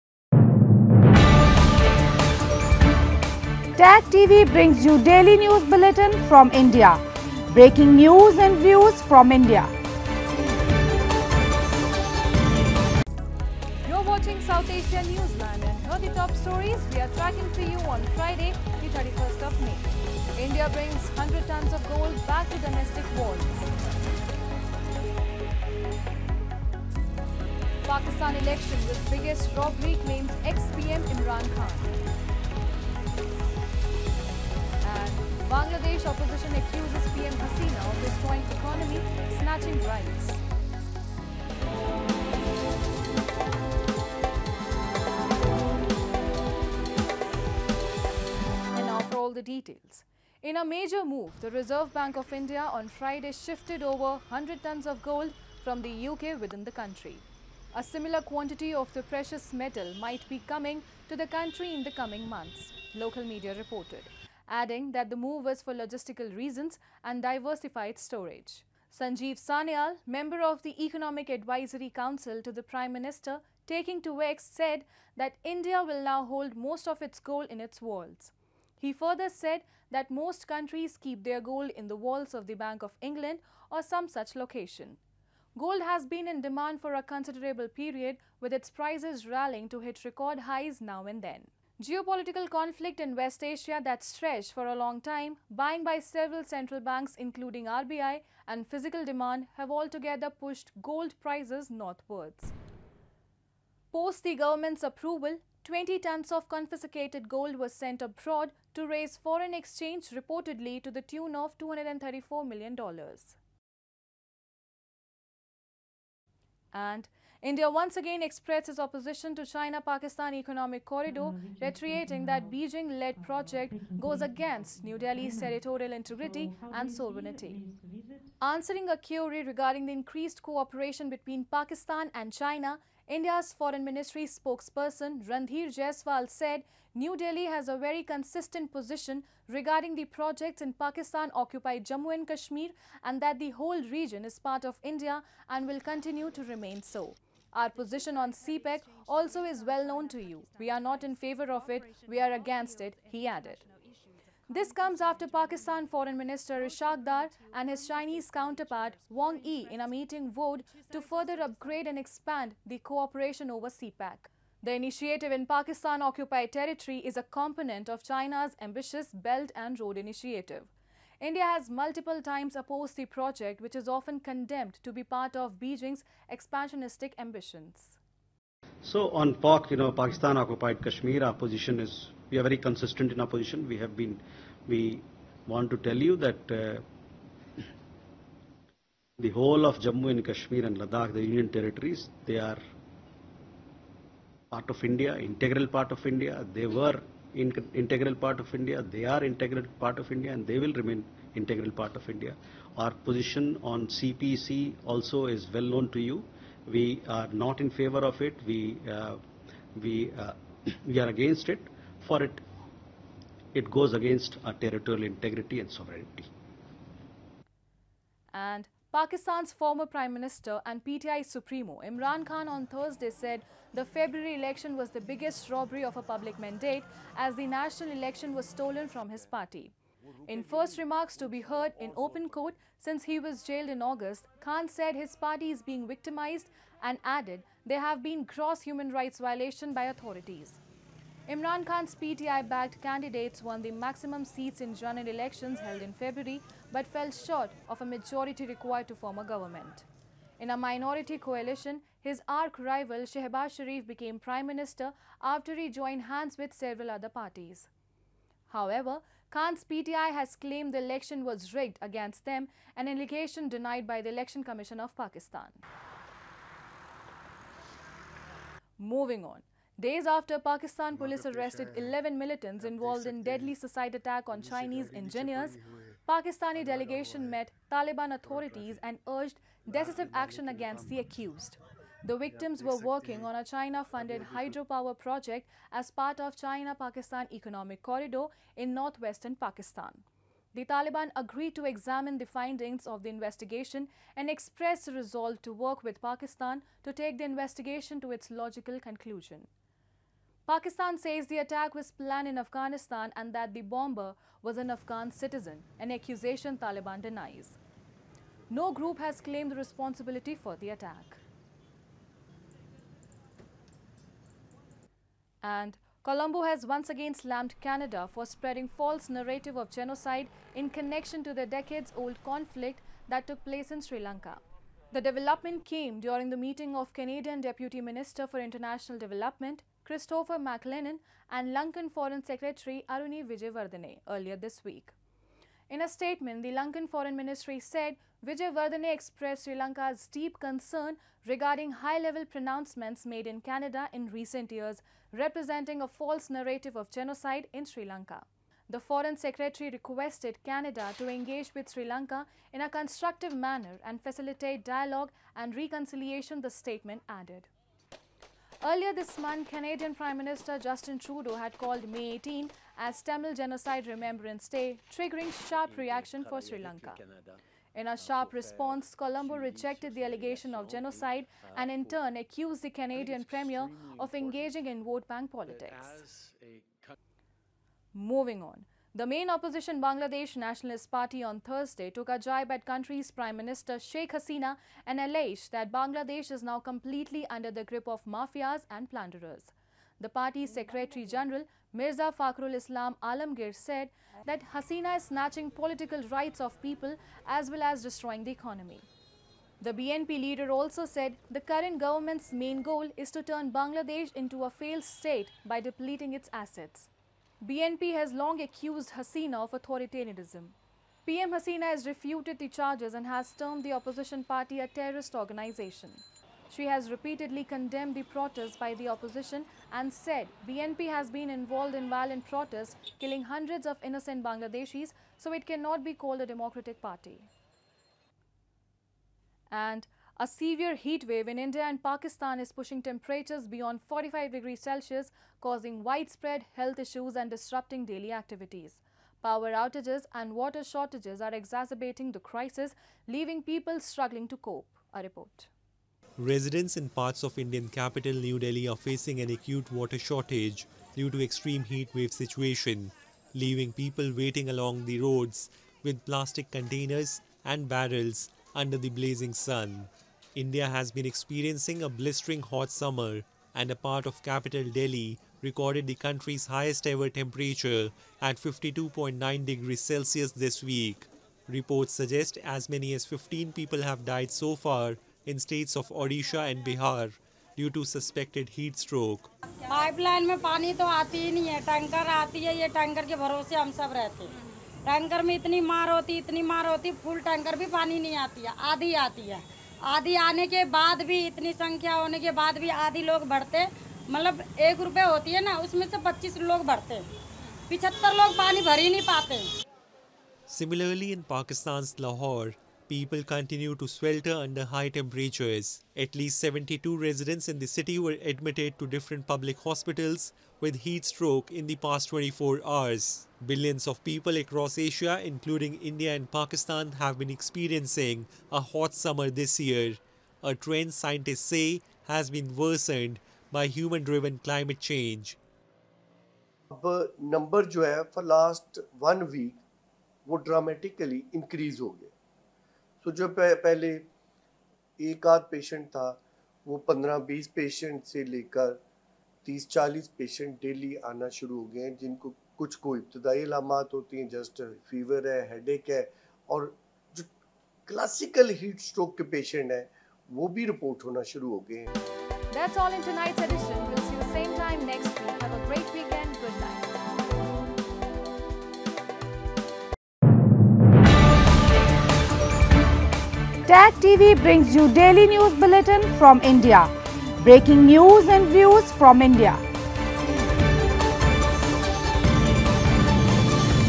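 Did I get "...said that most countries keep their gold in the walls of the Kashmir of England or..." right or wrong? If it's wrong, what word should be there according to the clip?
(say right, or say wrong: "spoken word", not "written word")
wrong: "Bank", not "Kashmir".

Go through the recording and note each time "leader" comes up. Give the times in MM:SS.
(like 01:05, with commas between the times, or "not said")
06:40.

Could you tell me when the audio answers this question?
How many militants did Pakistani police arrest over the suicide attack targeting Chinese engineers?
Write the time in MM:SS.
04:31.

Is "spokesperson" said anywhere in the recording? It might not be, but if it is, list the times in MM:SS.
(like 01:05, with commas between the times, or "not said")
02:14.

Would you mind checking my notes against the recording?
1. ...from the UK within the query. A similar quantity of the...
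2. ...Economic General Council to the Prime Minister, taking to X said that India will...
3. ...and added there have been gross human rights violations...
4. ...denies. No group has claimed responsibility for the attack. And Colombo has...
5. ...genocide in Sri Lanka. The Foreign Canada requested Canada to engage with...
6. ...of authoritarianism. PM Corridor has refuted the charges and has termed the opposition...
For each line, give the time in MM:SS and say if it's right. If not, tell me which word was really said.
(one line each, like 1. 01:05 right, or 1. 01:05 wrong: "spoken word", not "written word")
1. 00:55 wrong: "country", not "query"
2. 01:10 wrong: "Advisory", not "General"
3. 03:56 right
4. 05:07 right
5. 05:46 wrong: "Secretary", not "Canada"
6. 06:49 wrong: "Hasina", not "Corridor".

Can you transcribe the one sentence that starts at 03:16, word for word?
They were in integral part of India, they are integral part of India and they will remain integral part of India.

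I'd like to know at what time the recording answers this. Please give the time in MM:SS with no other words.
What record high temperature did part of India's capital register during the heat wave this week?
07:48.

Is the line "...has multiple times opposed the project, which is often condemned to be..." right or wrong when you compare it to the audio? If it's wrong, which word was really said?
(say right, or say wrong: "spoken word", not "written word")
right.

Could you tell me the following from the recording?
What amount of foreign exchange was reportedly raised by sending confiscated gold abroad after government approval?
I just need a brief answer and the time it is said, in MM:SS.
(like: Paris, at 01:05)
$234 million, at 01:51.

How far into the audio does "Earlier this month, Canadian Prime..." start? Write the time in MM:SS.
05:58.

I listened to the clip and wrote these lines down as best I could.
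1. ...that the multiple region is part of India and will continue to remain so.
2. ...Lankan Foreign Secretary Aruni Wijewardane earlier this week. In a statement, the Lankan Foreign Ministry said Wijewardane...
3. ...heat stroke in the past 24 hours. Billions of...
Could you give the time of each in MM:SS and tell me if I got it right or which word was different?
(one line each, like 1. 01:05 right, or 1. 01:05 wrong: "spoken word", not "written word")
1. 02:23 wrong: "whole", not "multiple"
2. 05:31 right
3. 08:30 right.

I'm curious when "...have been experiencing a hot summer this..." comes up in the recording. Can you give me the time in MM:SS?
08:37.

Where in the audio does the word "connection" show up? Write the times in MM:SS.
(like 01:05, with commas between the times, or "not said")
05:20.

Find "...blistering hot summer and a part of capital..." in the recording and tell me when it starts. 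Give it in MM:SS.
07:41.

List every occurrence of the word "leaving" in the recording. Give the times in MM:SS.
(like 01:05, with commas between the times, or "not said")
07:23, 07:33.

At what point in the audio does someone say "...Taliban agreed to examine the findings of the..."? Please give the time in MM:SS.
04:50.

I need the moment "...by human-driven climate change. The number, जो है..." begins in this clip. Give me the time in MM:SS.
08:43.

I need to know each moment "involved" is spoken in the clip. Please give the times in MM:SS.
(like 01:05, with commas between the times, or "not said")
04:32, 07:01.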